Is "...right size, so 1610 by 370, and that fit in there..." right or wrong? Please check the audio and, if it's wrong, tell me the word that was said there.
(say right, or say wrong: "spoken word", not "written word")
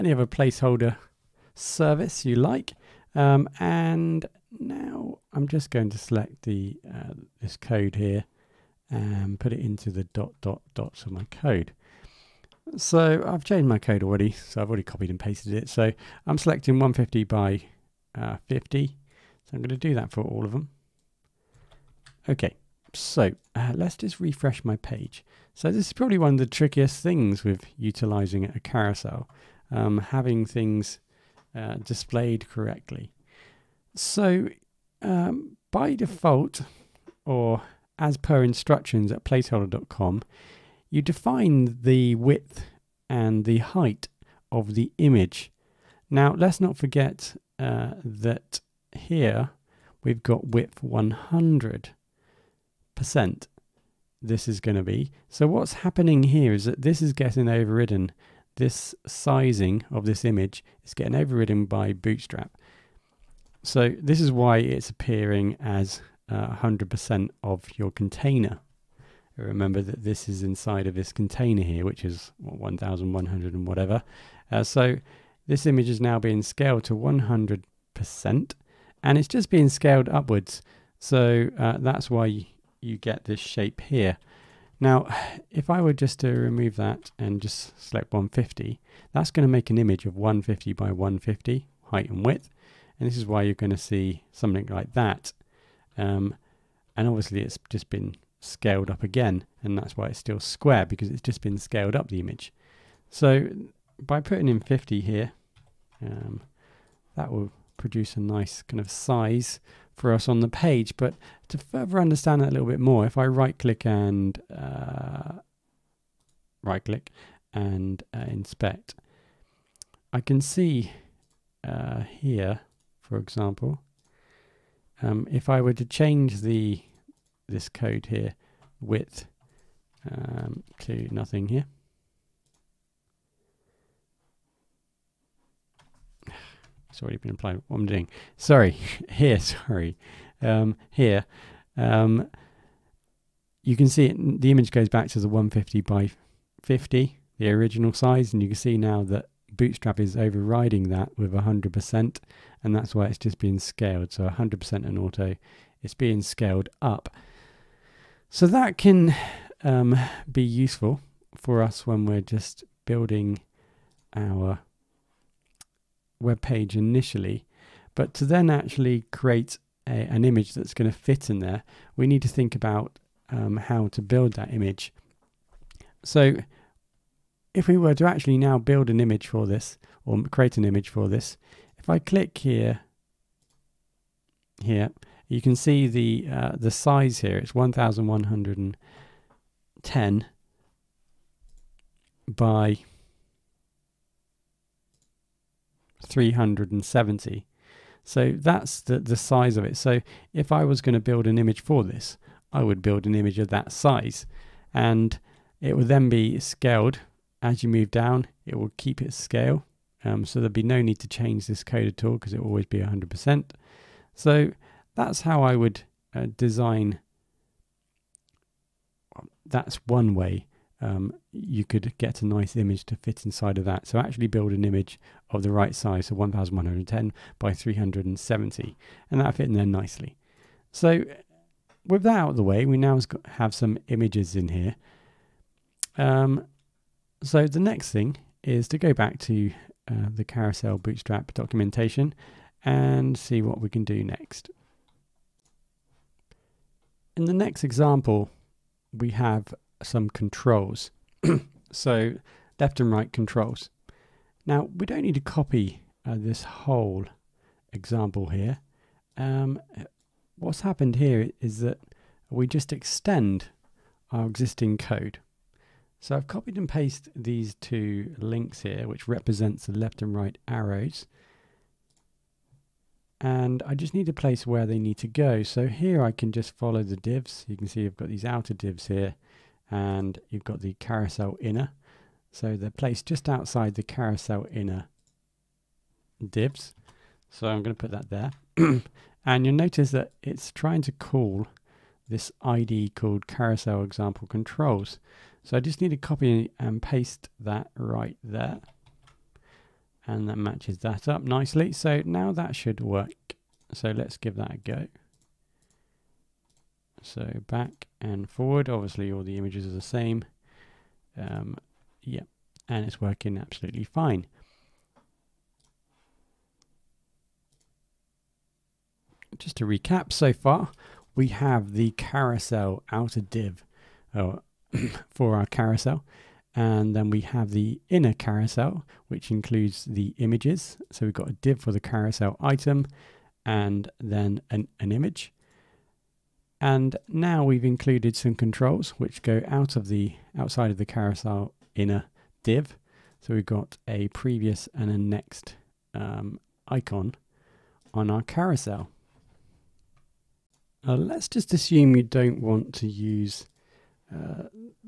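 wrong: "1110", not "1610".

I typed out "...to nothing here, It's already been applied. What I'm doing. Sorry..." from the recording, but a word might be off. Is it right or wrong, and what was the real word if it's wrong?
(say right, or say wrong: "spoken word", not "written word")
right.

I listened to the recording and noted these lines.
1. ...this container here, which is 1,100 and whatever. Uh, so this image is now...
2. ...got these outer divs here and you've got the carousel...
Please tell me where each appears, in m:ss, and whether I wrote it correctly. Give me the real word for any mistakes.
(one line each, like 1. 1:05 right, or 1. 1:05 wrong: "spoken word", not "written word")
1. 1:10 right
2. 4:37 right.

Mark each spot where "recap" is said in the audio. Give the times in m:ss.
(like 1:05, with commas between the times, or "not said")
5:19.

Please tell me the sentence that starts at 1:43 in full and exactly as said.
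So by putting in 50 here, um, that will produce a nice kind of size for us on the page.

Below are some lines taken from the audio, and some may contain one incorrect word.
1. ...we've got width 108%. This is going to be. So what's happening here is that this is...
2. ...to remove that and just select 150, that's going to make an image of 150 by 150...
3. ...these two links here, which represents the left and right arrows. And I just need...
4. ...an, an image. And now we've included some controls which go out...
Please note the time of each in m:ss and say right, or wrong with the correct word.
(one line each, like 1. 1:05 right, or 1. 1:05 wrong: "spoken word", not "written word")
1. 0:50 wrong: "100", not "108"
2. 1:26 right
3. 4:27 right
4. 5:34 right.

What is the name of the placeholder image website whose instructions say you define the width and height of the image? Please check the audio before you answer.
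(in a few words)
placeholder.com.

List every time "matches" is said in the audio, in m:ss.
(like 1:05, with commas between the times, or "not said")
5:00.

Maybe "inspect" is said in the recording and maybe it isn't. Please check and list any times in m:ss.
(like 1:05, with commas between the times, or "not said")
1:58.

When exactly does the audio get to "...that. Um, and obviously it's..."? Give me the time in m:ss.
1:34.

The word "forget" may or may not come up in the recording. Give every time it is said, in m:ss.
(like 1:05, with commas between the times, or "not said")
0:46.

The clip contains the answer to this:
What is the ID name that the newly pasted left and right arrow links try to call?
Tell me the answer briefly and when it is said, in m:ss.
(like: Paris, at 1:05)
carousel example controls, at 4:53.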